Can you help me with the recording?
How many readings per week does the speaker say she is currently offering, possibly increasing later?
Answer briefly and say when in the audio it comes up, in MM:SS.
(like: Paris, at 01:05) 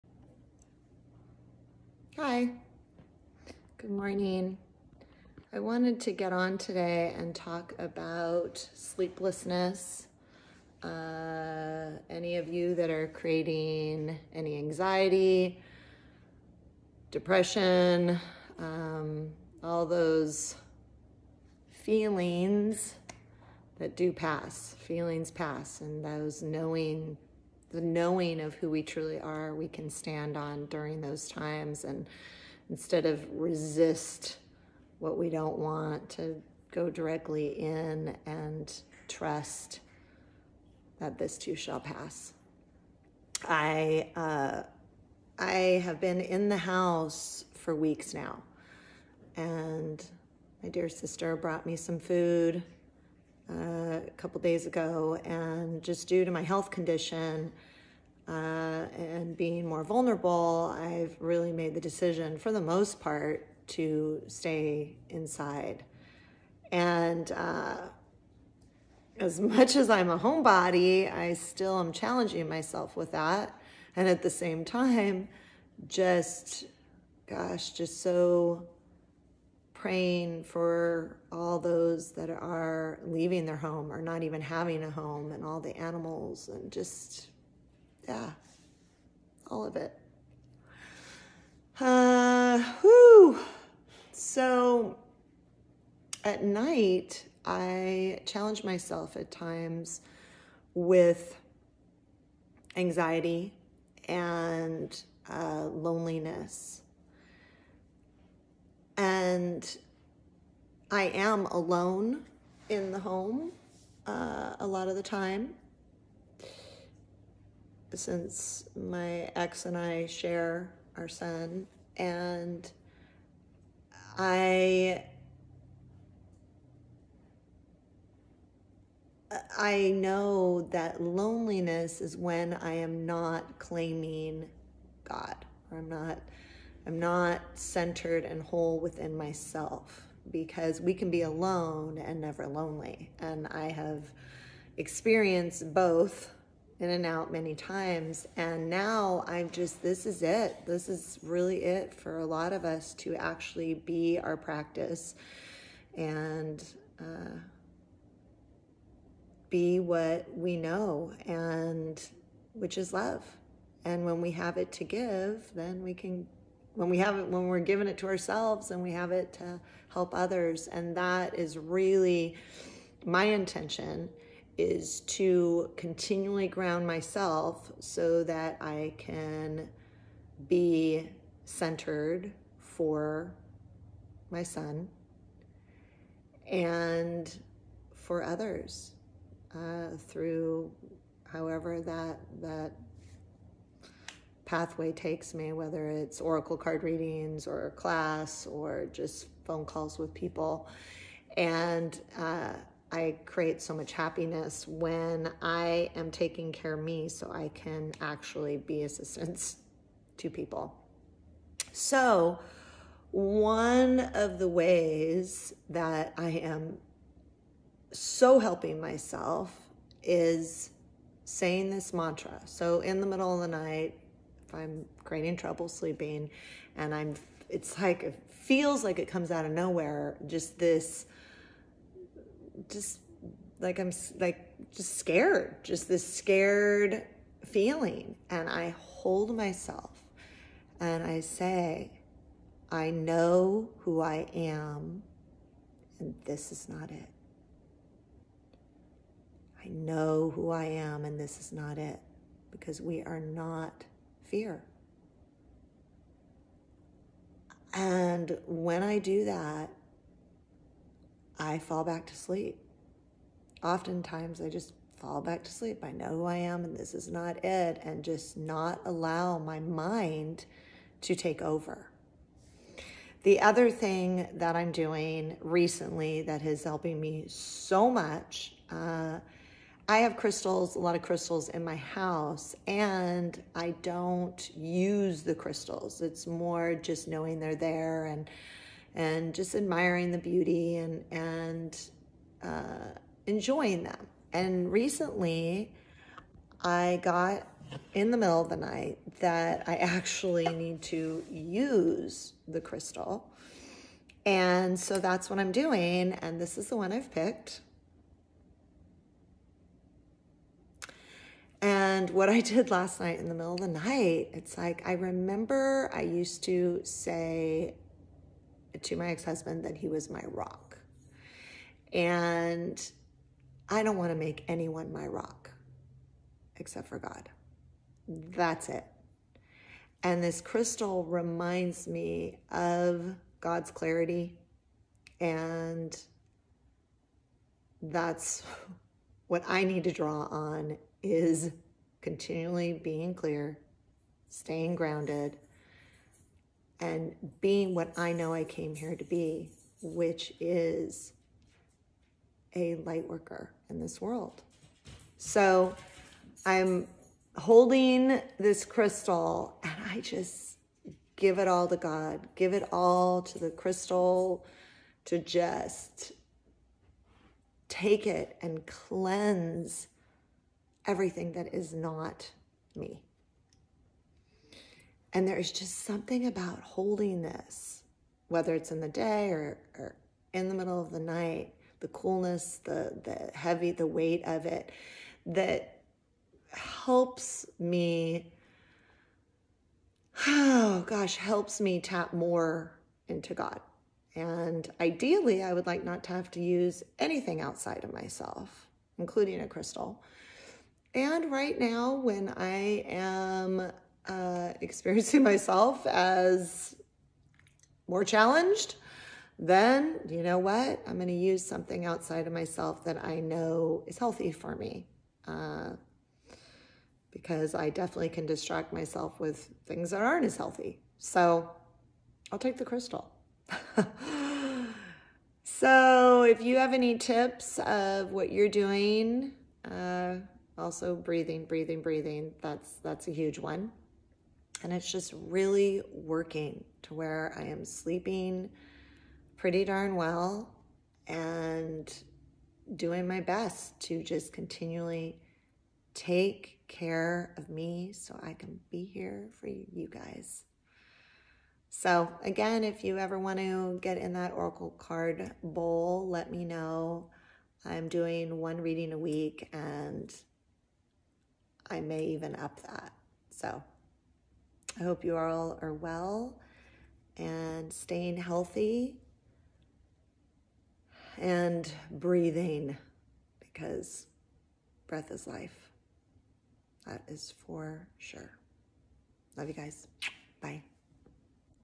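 1 reading a week, at 07:38.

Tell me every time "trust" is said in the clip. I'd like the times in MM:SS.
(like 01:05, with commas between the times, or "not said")
00:39.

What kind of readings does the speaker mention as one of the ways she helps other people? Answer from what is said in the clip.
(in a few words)
Oracle card readings.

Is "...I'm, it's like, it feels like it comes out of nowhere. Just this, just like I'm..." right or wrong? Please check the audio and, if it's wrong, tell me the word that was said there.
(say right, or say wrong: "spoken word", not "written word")
right.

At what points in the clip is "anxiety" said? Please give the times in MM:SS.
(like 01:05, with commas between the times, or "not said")
00:14, 01:42.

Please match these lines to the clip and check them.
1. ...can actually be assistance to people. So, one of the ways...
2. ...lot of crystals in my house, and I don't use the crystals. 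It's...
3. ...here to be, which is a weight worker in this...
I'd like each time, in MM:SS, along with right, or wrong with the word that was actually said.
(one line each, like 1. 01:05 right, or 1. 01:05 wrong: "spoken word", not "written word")
1. 03:27 right
2. 04:40 right
3. 05:48 wrong: "light", not "weight".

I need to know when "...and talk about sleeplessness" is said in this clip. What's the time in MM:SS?
00:07.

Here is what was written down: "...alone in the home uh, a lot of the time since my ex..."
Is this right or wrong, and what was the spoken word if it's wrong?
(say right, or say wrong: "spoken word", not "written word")
right.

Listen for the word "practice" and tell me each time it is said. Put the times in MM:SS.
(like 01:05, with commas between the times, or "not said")
02:34.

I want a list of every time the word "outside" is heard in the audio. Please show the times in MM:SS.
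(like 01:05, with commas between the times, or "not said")
06:37, 06:51.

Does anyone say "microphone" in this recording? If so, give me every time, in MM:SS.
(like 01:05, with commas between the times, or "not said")
not said.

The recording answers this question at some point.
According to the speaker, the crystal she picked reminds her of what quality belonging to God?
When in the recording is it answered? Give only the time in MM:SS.
05:33.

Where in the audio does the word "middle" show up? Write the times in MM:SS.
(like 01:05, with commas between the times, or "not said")
03:43, 04:58, 05:13, 06:20.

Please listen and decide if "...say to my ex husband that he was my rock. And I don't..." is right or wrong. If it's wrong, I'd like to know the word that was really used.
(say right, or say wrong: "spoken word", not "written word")
right.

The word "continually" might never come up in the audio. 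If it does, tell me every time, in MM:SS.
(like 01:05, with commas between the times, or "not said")
02:55, 05:42, 07:24.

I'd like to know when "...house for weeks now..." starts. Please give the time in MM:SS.
00:46.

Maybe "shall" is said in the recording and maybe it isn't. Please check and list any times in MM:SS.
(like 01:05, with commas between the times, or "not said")
00:41.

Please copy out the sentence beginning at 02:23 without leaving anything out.
And I have experienced both in and out many times.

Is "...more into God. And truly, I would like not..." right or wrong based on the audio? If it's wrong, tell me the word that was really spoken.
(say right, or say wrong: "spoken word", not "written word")
wrong: "ideally", not "truly".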